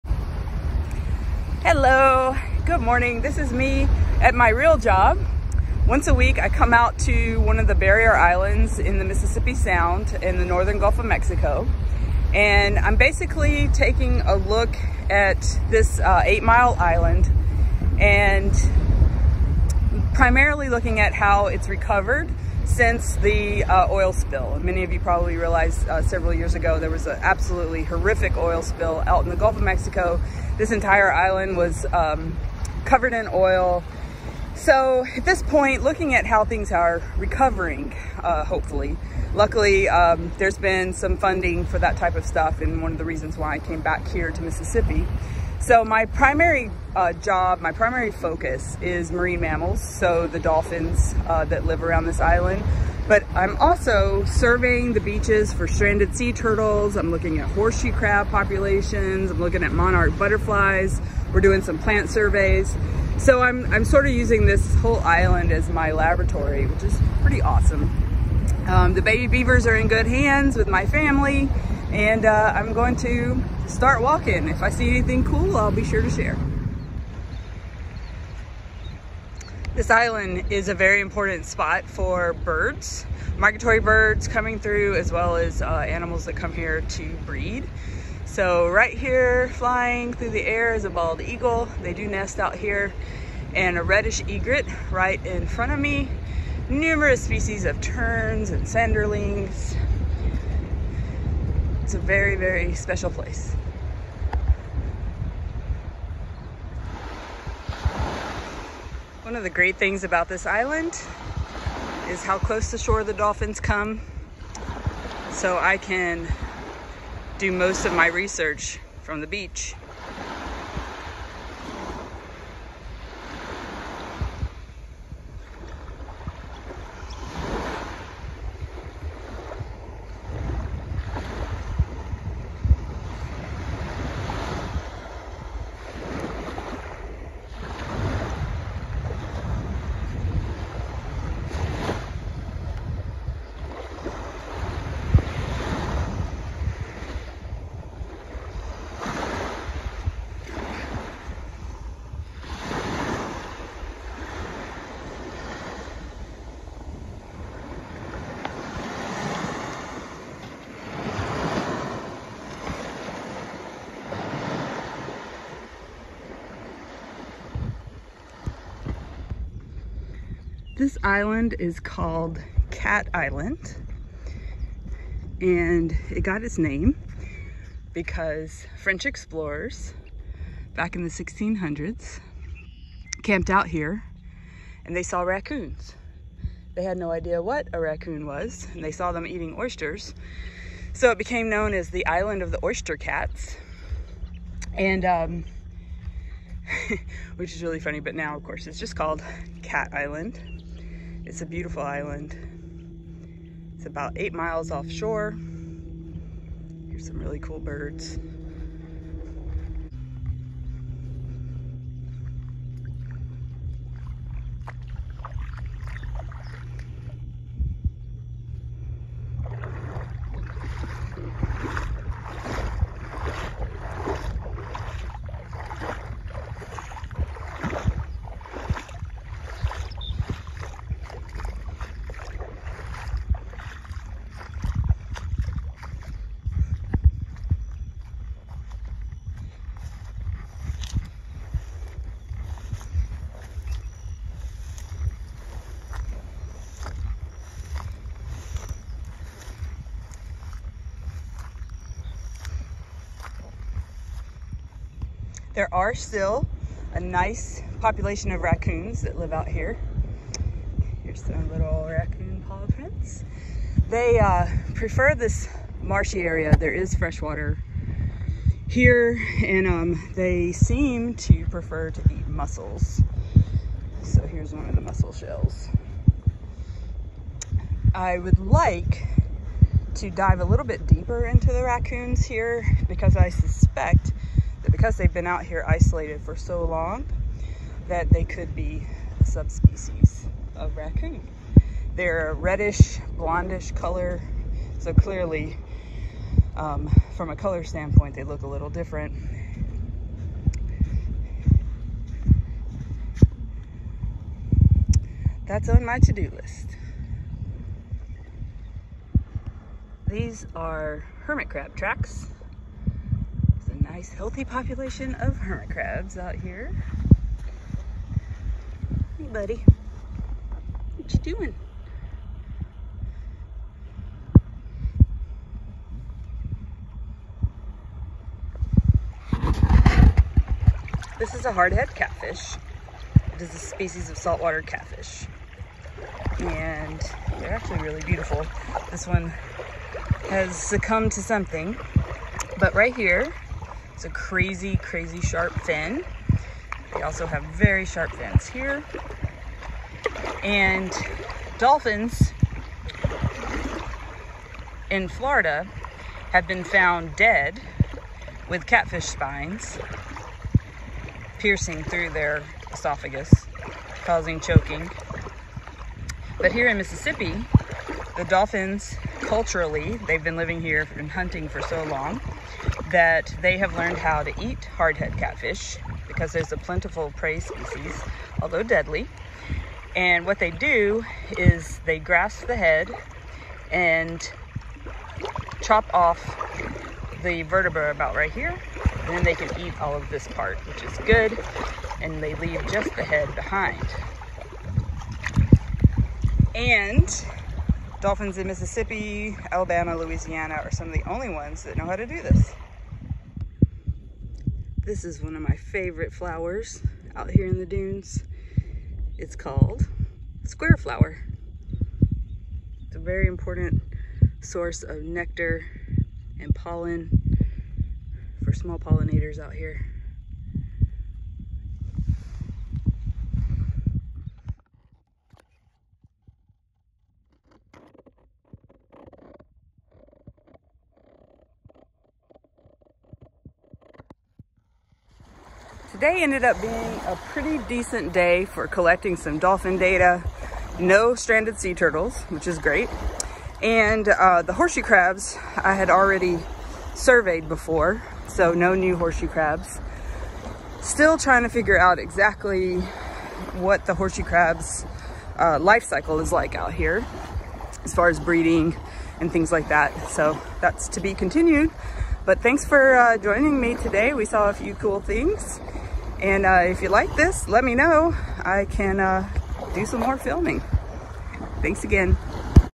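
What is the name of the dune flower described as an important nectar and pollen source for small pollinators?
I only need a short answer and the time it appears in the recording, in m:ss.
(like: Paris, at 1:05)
Square flower, at 6:50.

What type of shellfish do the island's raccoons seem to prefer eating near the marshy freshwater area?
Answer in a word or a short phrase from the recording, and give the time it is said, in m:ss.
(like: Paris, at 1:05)
Mussels, at 4:32.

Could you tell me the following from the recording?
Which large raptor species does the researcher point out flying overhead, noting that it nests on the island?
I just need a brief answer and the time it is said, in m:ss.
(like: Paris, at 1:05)
Bald eagle, at 1:30.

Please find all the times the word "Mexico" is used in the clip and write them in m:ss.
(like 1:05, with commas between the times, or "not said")
0:11, 0:29.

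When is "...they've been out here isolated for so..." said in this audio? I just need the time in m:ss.
4:44.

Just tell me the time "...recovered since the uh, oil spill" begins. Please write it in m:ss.
0:21.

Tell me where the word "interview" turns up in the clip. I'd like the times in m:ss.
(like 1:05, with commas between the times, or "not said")
not said.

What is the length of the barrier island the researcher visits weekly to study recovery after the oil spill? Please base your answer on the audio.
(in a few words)
8 miles.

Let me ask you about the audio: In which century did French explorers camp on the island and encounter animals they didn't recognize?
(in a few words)
1600s.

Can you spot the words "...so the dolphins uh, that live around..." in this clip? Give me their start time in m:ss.
0:49.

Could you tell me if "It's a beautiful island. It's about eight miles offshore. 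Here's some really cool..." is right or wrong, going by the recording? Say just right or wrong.
right.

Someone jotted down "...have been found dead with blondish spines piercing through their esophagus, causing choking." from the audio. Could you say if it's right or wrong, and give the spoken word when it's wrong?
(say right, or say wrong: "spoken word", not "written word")
wrong: "catfish", not "blondish".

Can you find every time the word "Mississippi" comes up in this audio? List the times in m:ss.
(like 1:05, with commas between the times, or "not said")
0:09, 0:44, 6:06, 6:38.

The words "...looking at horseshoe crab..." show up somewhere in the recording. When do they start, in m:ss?
0:57.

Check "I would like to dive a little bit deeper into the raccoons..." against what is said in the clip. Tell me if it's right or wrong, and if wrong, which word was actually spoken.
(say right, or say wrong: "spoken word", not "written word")
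right.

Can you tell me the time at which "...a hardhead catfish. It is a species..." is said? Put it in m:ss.
5:31.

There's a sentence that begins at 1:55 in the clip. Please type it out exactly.
So I can do most of my research from the beach.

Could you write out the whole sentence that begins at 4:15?
There are still a nice population of raccoons that live out here.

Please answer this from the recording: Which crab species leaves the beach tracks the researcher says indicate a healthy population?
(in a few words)
Hermit crab.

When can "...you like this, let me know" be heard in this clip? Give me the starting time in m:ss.
7:46.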